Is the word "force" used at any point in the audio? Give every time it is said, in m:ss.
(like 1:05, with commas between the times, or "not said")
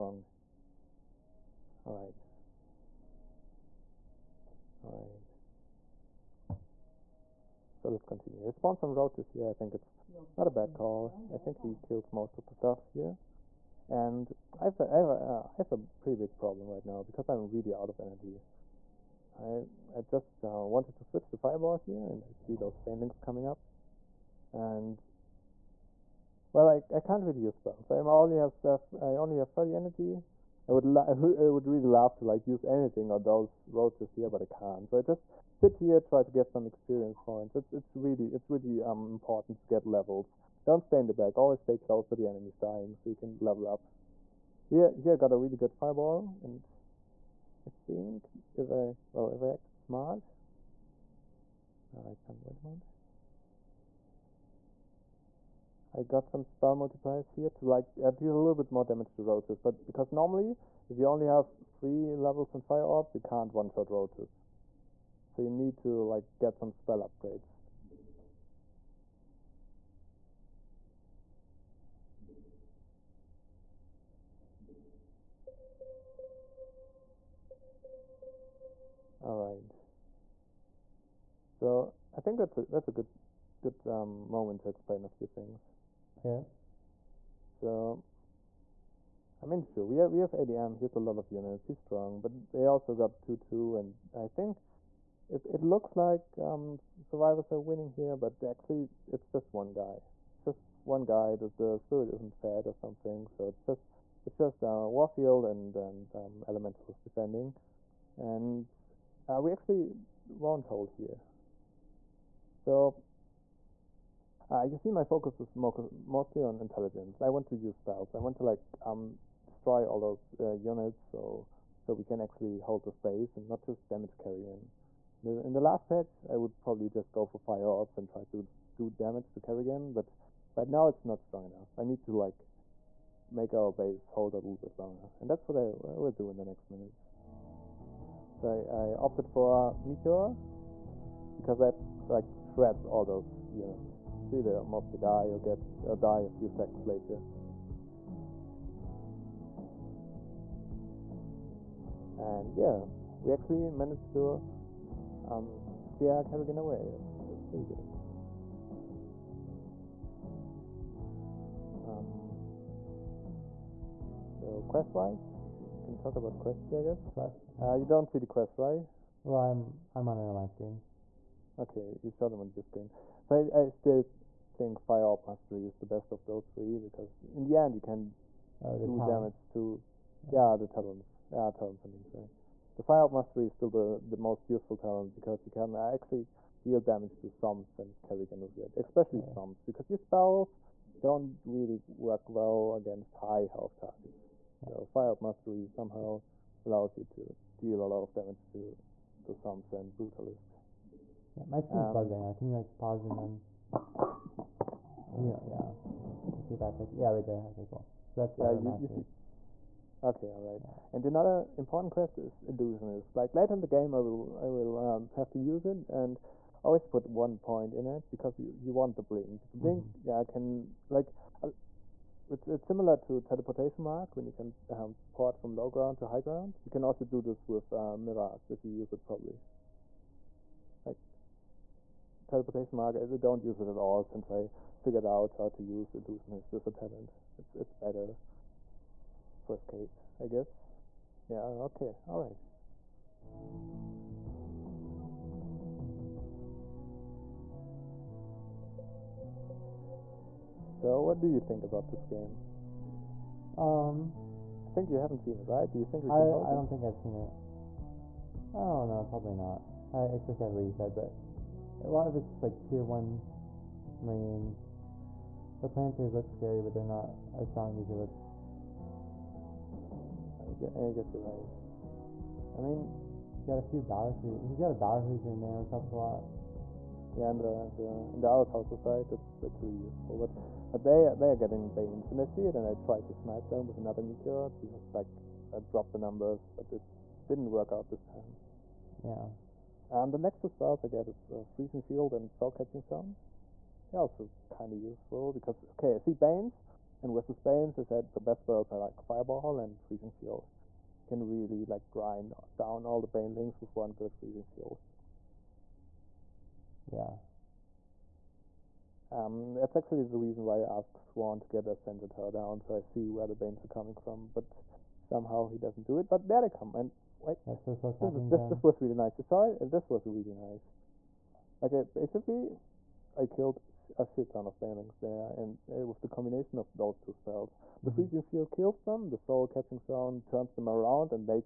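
not said.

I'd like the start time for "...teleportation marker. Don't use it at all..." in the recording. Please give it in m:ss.
3:52.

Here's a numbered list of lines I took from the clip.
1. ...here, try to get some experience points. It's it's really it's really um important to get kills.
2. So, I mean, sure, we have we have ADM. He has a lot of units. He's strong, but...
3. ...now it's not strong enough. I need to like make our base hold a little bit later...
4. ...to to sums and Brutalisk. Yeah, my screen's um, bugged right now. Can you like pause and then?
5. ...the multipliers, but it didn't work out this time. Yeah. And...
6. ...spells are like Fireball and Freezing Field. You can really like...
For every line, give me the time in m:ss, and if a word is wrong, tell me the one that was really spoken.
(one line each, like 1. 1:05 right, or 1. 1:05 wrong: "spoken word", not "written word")
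1. 0:35 wrong: "levels", not "kills"
2. 1:27 right
3. 2:10 wrong: "longer", not "later"
4. 3:18 right
5. 4:45 wrong: "numbers", not "multipliers"
6. 4:58 right.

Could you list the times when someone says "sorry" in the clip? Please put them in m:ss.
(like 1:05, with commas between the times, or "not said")
3:02, 5:19.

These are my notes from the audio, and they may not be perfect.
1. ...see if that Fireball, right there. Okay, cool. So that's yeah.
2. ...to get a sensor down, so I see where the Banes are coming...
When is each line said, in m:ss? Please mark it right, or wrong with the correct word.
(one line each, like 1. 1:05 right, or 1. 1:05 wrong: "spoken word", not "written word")
1. 3:26 wrong: "Yeah", not "Fireball"
2. 5:11 right.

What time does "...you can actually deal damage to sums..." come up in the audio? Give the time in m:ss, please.
3:05.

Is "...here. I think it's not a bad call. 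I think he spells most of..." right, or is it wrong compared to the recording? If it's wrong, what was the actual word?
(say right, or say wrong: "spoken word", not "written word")
wrong: "kills", not "spells".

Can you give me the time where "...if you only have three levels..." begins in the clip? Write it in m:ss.
1:00.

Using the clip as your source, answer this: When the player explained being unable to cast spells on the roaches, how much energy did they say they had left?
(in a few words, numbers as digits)
30.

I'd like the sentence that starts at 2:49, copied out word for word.
Well, I'm I'm on another screen.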